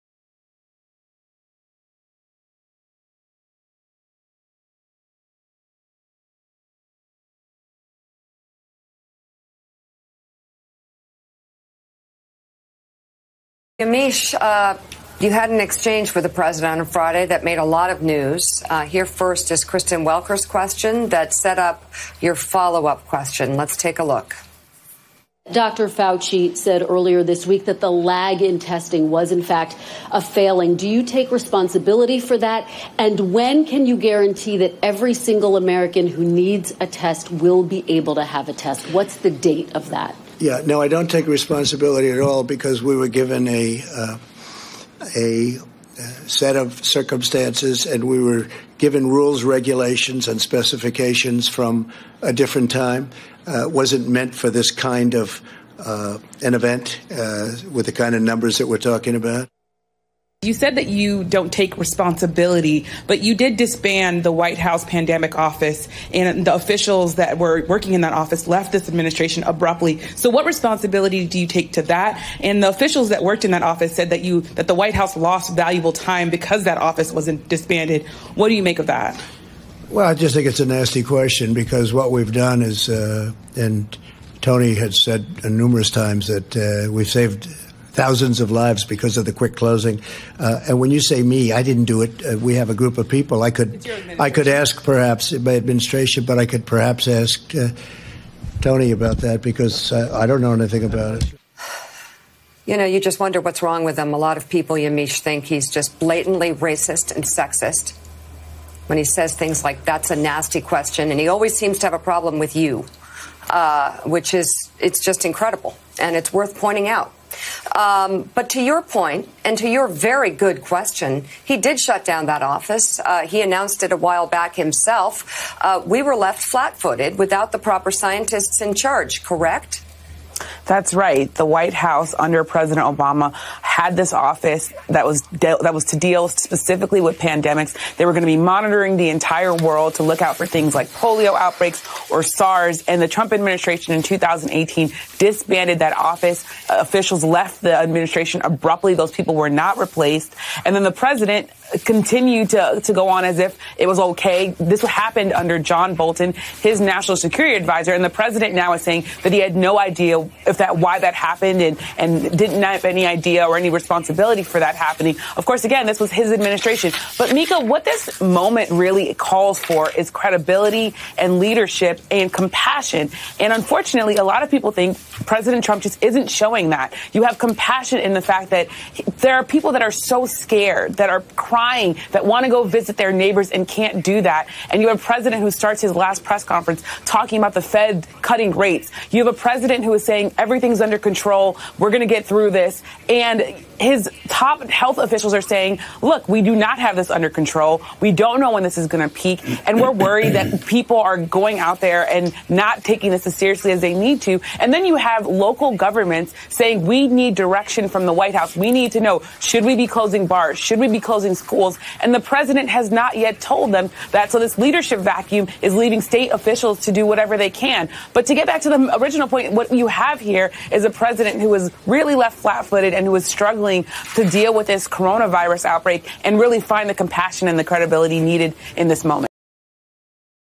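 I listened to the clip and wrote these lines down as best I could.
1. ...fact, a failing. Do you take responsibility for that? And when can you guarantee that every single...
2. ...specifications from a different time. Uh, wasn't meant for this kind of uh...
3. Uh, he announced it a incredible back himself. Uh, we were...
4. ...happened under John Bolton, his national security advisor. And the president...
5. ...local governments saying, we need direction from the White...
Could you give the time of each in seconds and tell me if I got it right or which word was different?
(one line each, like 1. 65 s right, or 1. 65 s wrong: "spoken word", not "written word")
1. 29 s right
2. 50 s right
3. 122 s wrong: "while", not "incredible"
4. 154 s right
5. 205 s right.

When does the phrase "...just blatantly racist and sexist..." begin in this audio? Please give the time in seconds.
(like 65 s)
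105 s.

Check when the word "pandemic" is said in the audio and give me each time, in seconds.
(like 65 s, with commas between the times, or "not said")
64 s, 137 s.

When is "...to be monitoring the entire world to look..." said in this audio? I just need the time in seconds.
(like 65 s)
138 s.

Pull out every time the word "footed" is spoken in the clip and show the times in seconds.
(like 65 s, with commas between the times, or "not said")
126 s, 222 s.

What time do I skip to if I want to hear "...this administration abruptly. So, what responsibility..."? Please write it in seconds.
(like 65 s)
68 s.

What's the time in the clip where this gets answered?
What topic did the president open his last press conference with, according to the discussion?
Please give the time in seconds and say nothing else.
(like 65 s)
187 s.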